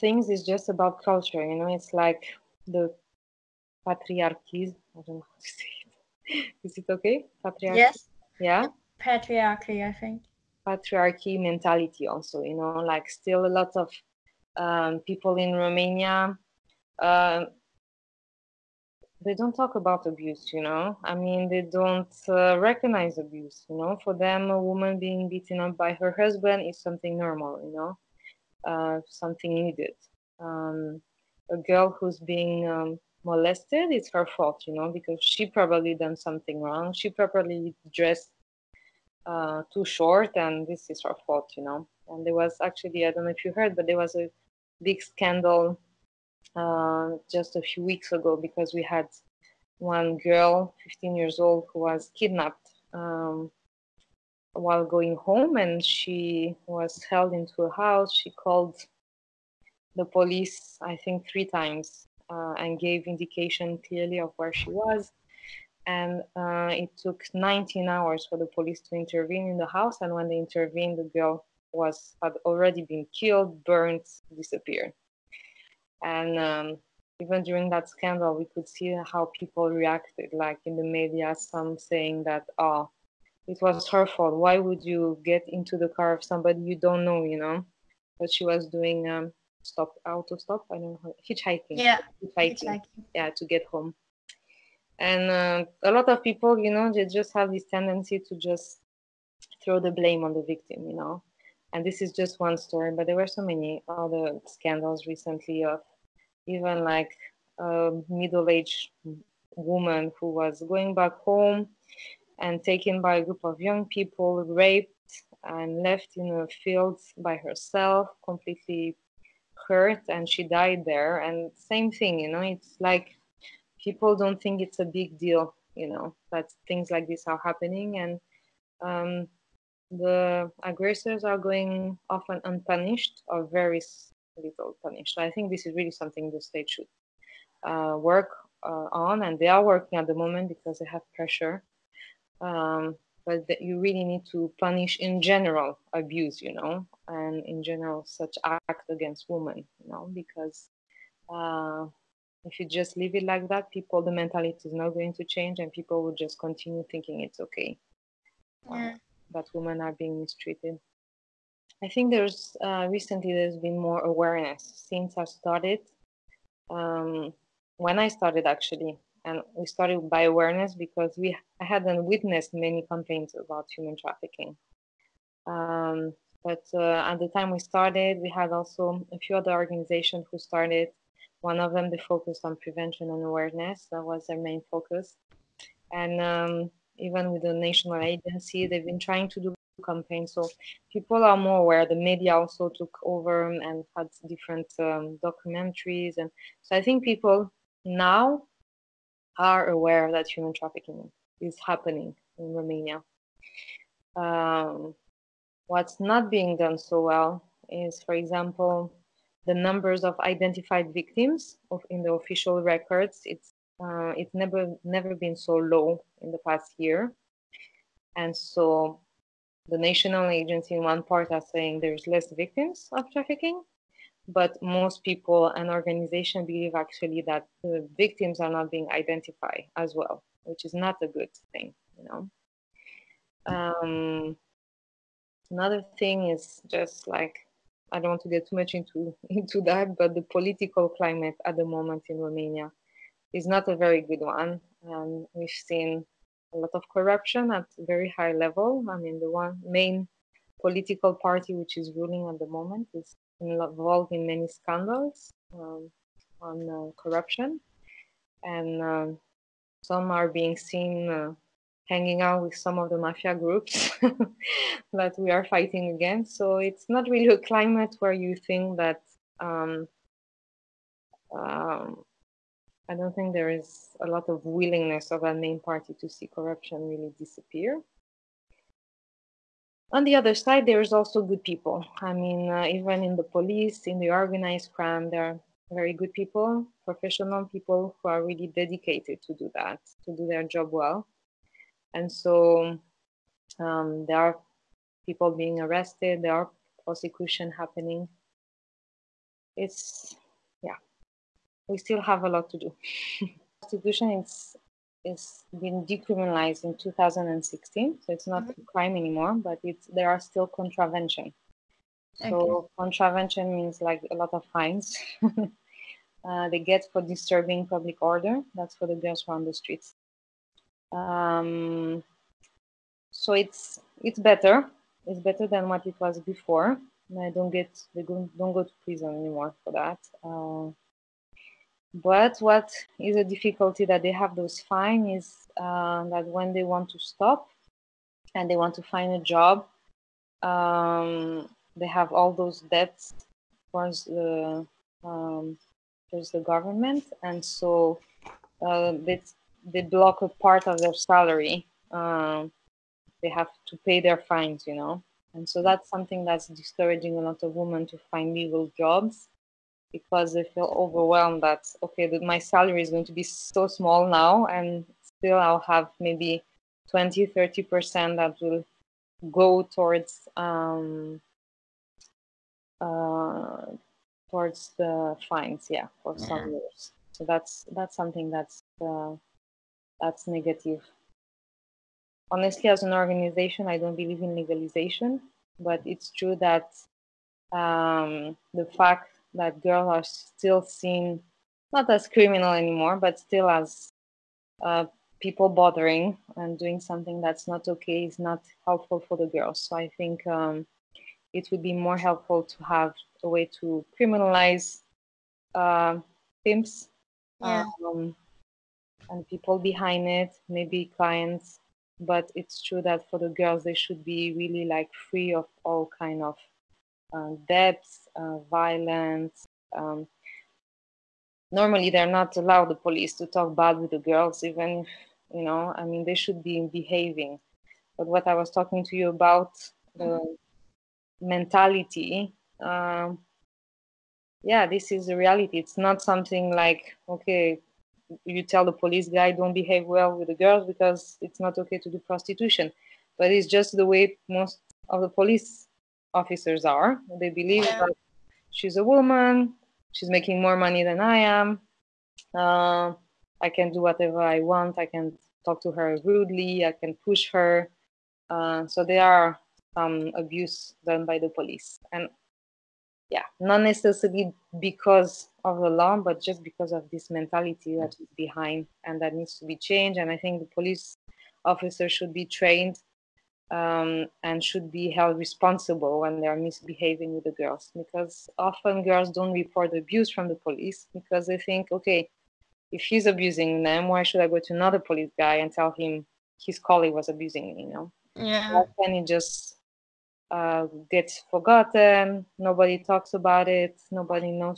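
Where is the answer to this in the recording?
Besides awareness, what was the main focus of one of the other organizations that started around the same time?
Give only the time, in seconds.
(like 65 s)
182 s.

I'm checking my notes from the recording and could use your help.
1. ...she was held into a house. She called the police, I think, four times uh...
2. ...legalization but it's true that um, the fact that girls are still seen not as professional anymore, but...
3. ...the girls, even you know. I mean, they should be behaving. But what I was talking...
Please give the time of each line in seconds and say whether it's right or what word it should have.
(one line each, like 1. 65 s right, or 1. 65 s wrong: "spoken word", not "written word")
1. 55 s wrong: "three", not "four"
2. 384 s wrong: "criminal", not "professional"
3. 423 s right.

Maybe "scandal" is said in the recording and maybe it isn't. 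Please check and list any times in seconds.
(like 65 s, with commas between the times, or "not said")
45 s, 77 s, 104 s, 254 s.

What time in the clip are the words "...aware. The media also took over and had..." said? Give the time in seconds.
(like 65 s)
191 s.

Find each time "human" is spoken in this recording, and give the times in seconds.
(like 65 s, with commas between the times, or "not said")
173 s, 200 s.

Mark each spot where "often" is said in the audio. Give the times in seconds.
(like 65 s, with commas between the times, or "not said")
132 s, 478 s.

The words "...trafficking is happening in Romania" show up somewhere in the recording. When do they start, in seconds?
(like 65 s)
200 s.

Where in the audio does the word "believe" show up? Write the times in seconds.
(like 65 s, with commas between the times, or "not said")
226 s, 383 s, 447 s.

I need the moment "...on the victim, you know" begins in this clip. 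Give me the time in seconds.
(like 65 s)
100 s.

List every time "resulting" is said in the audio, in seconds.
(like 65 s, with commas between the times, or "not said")
not said.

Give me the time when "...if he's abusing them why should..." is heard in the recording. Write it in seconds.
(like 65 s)
482 s.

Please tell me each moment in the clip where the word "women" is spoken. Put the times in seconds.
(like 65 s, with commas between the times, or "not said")
149 s, 159 s, 357 s.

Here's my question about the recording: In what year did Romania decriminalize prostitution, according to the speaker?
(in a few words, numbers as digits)
2016.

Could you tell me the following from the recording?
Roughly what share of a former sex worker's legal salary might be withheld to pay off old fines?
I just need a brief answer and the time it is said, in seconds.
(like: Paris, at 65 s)
20-30%, at 366 s.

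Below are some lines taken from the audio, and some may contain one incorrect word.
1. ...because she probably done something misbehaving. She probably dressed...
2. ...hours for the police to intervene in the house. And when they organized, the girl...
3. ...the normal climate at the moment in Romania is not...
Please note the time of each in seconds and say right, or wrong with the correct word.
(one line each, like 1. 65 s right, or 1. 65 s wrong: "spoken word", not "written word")
1. 34 s wrong: "wrong", not "misbehaving"
2. 67 s wrong: "intervened", not "organized"
3. 240 s wrong: "political", not "normal".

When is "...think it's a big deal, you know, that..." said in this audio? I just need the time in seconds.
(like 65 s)
124 s.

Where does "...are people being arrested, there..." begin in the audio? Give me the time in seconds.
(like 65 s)
294 s.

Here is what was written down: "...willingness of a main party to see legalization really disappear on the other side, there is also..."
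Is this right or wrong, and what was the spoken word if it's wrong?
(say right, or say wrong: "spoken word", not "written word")
wrong: "corruption", not "legalization".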